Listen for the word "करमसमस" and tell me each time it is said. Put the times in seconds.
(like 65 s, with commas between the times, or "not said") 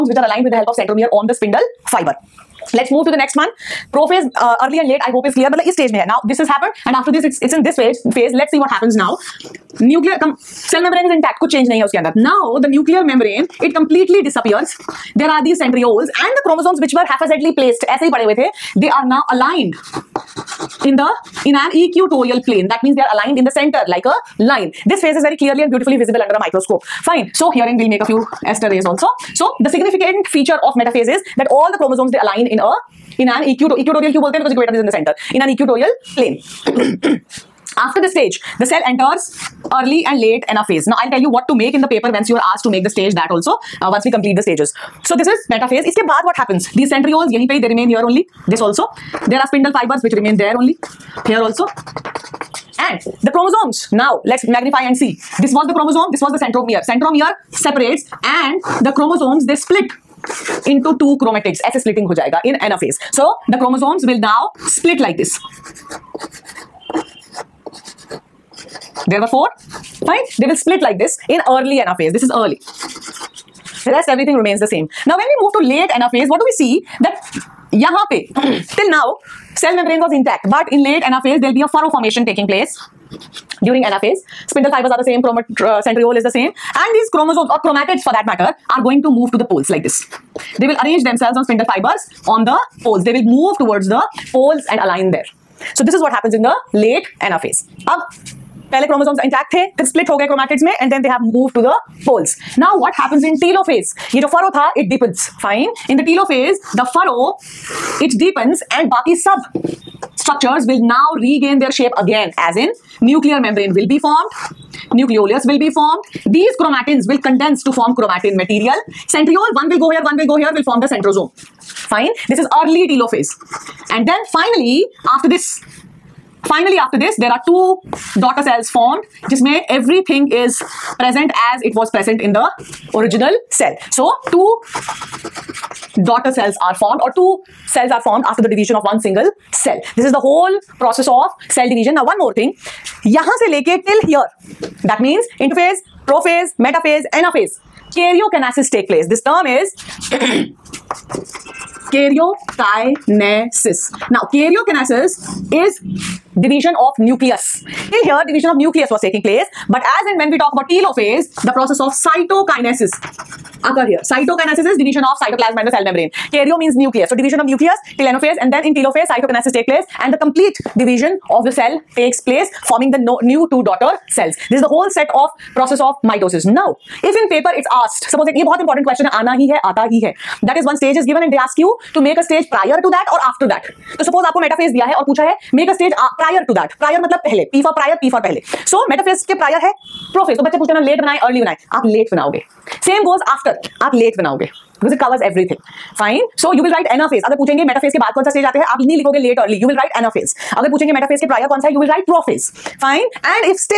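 16 s, 98 s.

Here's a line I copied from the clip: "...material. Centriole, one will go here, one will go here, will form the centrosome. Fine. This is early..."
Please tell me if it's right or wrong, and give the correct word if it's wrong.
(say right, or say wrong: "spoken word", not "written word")
right.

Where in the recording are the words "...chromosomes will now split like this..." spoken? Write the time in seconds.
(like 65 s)
63 s.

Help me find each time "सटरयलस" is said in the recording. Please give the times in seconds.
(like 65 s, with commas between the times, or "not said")
15 s.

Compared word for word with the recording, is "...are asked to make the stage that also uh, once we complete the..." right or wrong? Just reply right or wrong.
right.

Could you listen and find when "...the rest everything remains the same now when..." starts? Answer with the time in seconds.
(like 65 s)
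73 s.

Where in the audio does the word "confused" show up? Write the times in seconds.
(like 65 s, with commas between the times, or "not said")
not said.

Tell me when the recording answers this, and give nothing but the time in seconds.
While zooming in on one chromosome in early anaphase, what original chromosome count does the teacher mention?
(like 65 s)
69 s.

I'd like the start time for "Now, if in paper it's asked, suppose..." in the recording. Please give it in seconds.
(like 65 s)
176 s.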